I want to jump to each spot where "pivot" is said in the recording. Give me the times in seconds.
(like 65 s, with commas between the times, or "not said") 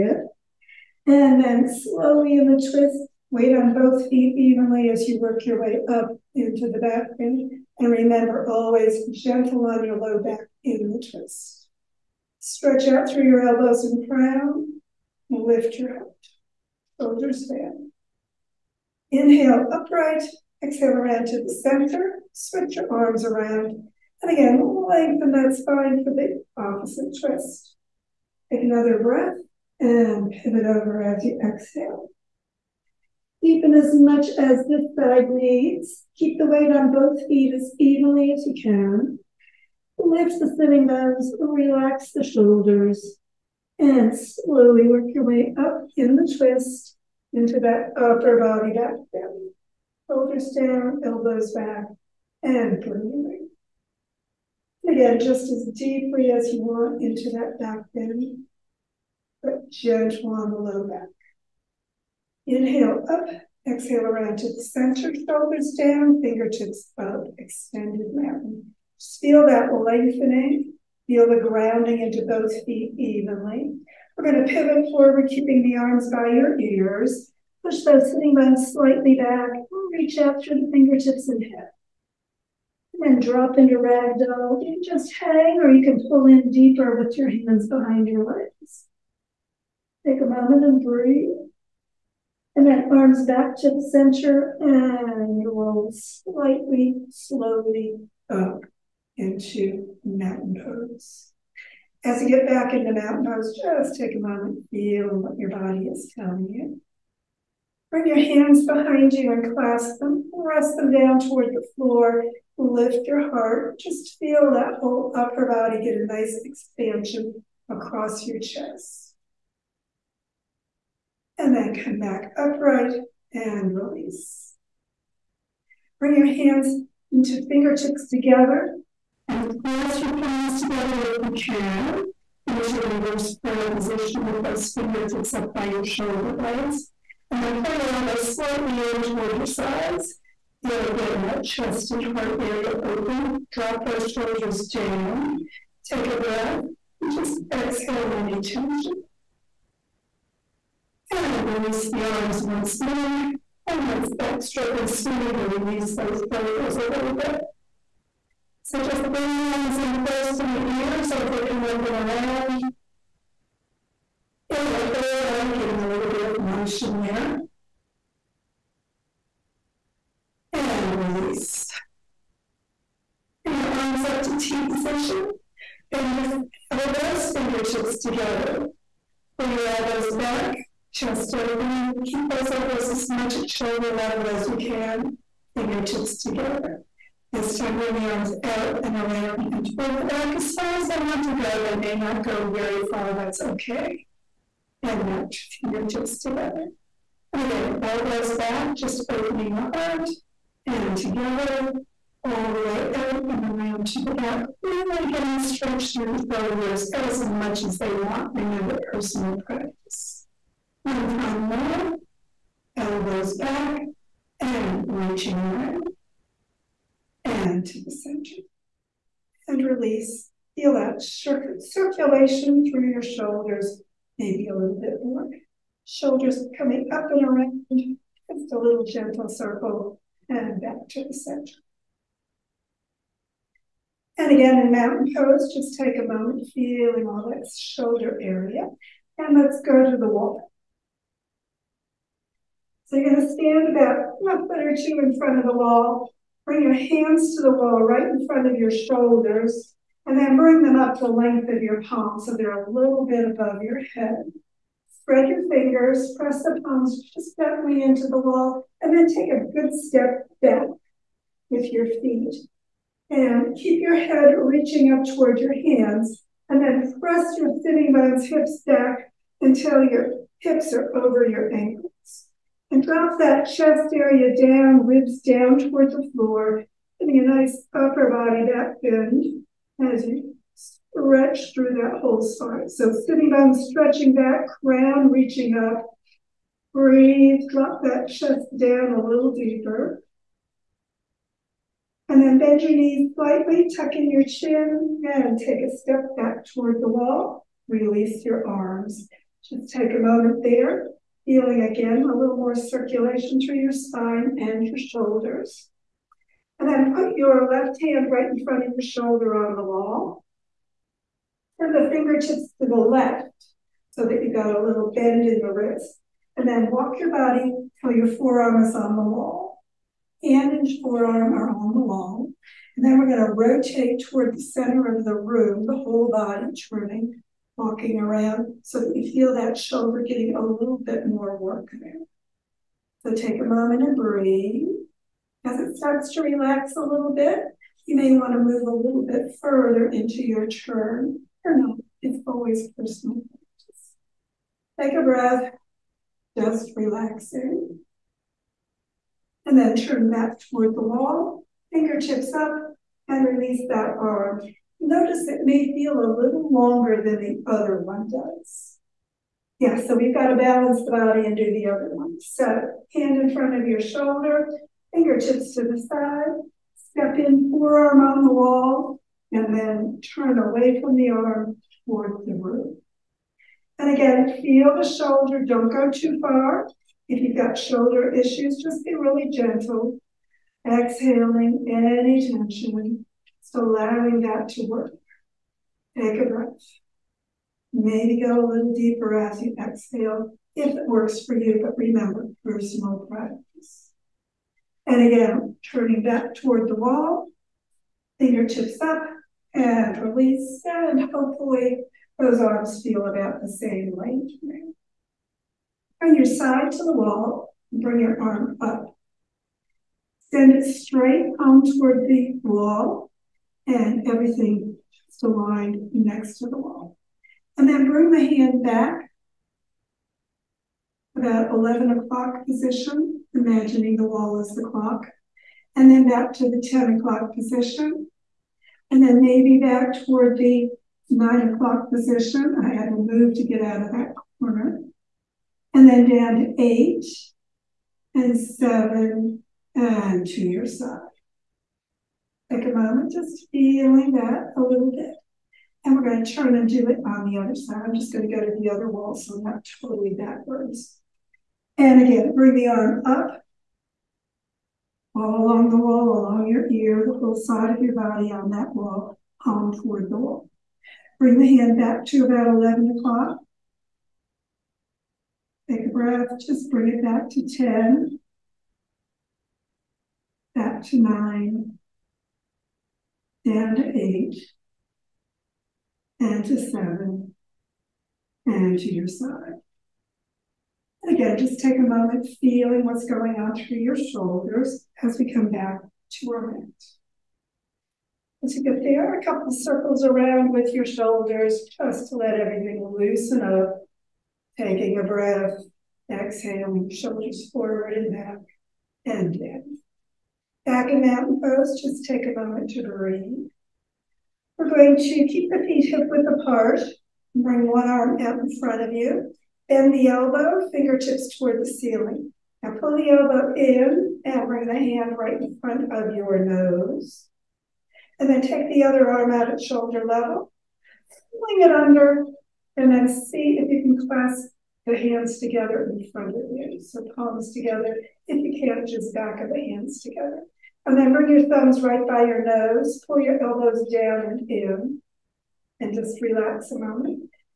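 30 s, 74 s.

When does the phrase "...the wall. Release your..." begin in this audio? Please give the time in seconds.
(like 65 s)
296 s.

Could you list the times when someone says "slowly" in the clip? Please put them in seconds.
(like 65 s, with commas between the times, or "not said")
1 s, 44 s, 97 s.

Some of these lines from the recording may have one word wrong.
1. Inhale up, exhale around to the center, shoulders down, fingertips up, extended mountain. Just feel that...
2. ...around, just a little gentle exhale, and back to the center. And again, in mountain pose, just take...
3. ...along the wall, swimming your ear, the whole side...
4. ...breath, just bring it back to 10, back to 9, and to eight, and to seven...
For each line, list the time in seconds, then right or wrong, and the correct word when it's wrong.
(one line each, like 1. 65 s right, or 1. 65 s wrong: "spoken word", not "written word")
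1. 62 s right
2. 227 s wrong: "circle", not "exhale"
3. 455 s wrong: "along", not "swimming"
4. 465 s right.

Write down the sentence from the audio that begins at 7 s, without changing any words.
And remember, always gentle on your low back in the twist.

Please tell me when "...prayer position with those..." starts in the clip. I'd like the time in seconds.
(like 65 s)
133 s.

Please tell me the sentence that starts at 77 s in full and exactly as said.
Push those sitting bones slightly back.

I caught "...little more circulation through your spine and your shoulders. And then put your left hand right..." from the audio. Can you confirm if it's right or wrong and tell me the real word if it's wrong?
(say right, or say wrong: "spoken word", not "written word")
right.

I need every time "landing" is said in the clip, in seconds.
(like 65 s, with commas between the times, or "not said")
not said.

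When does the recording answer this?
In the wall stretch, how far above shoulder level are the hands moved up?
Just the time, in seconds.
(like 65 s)
251 s.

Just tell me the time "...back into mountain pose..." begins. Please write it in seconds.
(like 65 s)
102 s.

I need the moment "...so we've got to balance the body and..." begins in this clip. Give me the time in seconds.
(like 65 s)
359 s.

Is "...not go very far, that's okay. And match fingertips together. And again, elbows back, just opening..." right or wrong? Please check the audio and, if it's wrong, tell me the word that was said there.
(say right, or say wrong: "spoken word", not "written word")
right.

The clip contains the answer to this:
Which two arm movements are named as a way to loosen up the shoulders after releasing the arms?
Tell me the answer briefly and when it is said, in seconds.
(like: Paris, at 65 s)
backstroke and swimming, at 154 s.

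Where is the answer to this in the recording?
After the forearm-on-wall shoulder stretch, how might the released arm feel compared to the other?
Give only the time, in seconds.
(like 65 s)
355 s.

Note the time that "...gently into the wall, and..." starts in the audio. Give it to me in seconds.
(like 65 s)
257 s.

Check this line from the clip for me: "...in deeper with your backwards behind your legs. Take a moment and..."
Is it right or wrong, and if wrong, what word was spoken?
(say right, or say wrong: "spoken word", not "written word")
wrong: "hands", not "backwards".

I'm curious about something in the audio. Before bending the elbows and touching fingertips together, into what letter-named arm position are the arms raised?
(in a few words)
T position.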